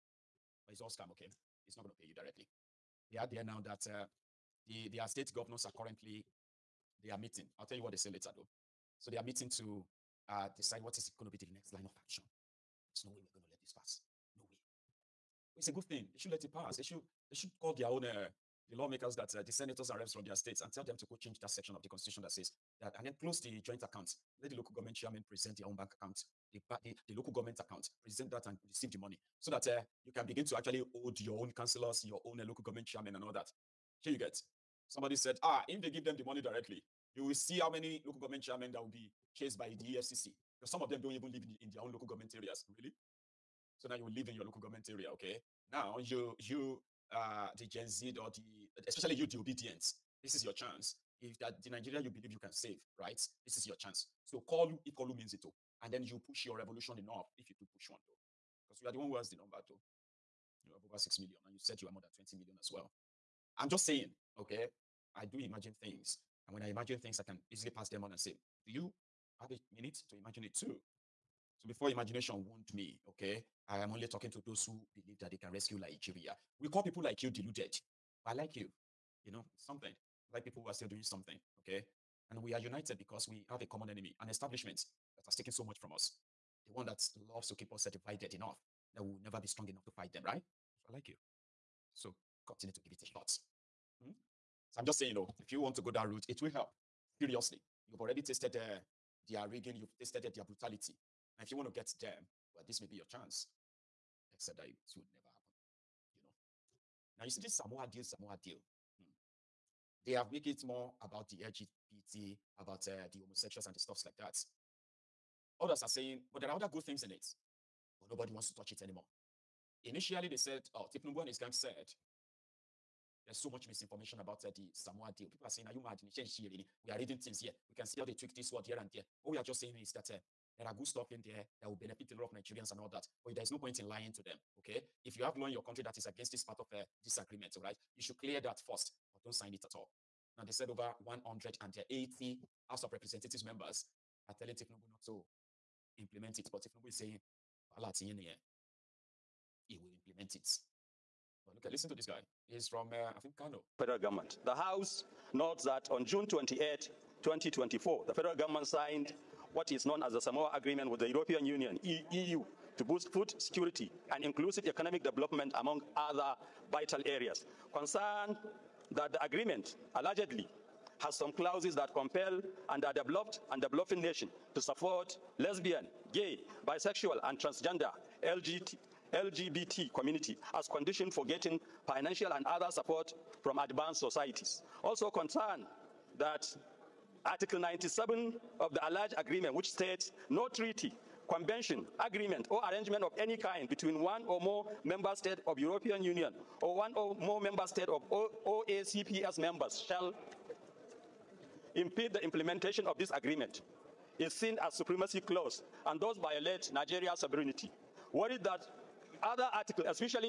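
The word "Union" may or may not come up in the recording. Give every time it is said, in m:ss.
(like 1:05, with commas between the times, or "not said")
2:41, 3:16.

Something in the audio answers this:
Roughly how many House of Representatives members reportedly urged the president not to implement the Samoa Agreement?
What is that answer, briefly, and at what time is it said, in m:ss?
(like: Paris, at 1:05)
180, at 2:20.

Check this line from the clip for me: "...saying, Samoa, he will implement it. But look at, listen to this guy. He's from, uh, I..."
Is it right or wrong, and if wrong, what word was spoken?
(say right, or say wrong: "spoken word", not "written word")
wrong: "Allah", not "Samoa".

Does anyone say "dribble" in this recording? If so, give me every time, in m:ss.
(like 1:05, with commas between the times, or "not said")
not said.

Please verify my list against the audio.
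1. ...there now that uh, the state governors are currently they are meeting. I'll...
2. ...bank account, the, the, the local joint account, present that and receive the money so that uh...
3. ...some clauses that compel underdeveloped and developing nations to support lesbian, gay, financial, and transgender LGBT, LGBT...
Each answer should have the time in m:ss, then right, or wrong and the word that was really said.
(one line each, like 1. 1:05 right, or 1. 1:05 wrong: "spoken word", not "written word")
1. 0:03 right
2. 0:25 wrong: "government", not "joint"
3. 2:51 wrong: "bisexual", not "financial".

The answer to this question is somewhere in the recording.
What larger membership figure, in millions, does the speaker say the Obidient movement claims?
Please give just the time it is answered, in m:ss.
1:02.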